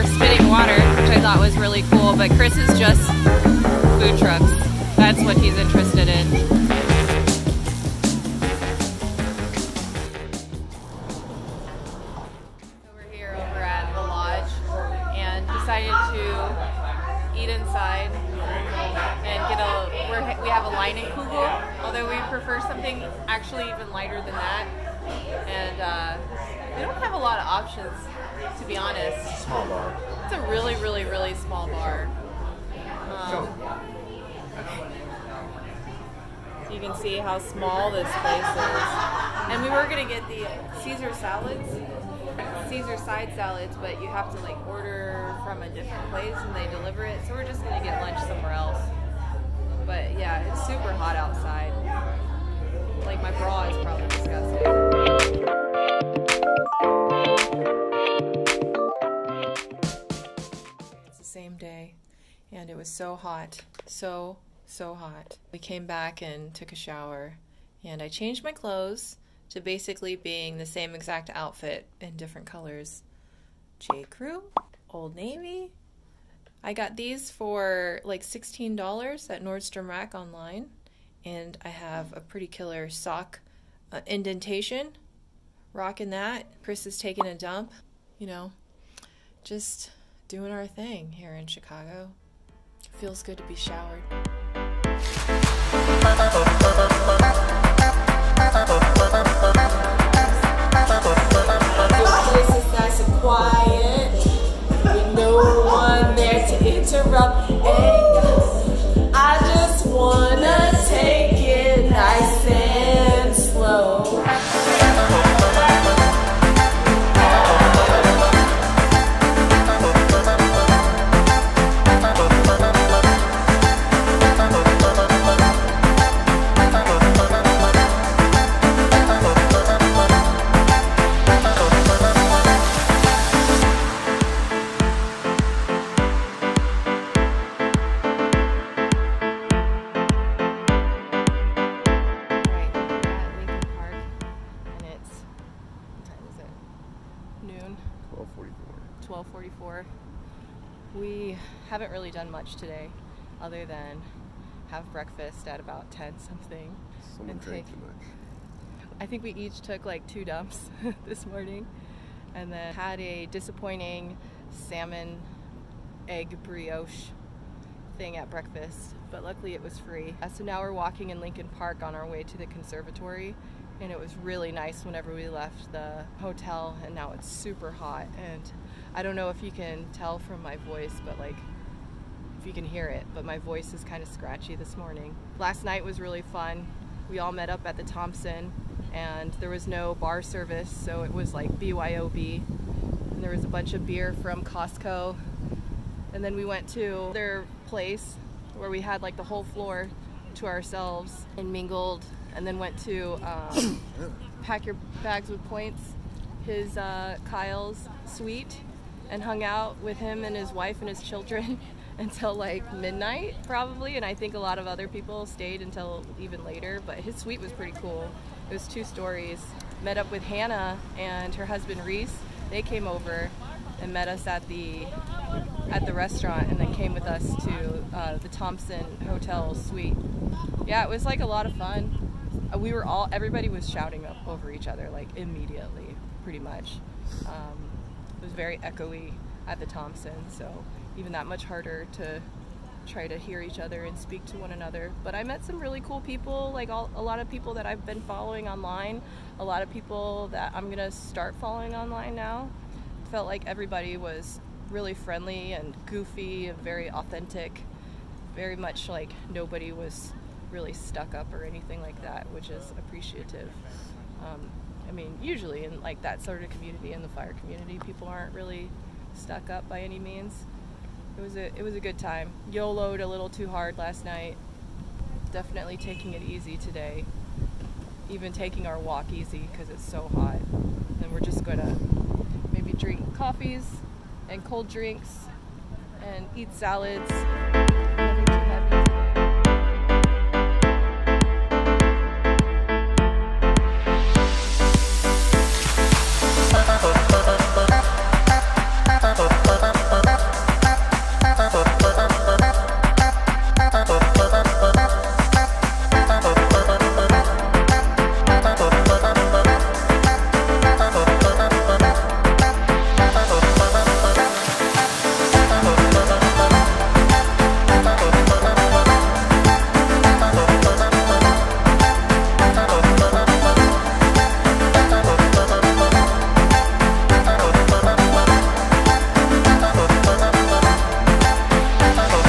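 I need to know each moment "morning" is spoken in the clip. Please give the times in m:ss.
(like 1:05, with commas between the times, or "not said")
2:41, 3:04.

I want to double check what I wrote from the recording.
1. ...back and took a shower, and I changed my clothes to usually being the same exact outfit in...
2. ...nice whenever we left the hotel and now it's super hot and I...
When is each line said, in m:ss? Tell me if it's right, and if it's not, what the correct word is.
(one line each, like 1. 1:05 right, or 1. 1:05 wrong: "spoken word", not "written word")
1. 1:05 wrong: "basically", not "usually"
2. 2:54 right.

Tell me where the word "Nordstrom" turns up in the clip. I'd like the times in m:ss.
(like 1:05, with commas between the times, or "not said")
1:19.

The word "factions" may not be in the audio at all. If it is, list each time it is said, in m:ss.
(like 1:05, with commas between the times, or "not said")
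not said.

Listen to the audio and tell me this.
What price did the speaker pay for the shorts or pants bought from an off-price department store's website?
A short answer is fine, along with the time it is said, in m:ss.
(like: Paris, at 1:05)
$16, at 1:18.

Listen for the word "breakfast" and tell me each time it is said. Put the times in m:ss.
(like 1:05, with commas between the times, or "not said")
2:34, 2:48.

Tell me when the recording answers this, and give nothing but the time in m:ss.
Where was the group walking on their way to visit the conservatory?
2:51.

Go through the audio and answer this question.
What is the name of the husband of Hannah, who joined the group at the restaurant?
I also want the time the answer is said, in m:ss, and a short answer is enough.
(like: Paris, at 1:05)
Reese, at 3:41.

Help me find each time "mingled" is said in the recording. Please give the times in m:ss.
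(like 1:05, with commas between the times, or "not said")
3:21.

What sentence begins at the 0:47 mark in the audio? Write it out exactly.
So we're just gonna get lunch somewhere else.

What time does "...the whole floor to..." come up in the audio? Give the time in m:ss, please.
3:19.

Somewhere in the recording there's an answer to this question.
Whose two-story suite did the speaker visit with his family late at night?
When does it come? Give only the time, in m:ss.
3:27.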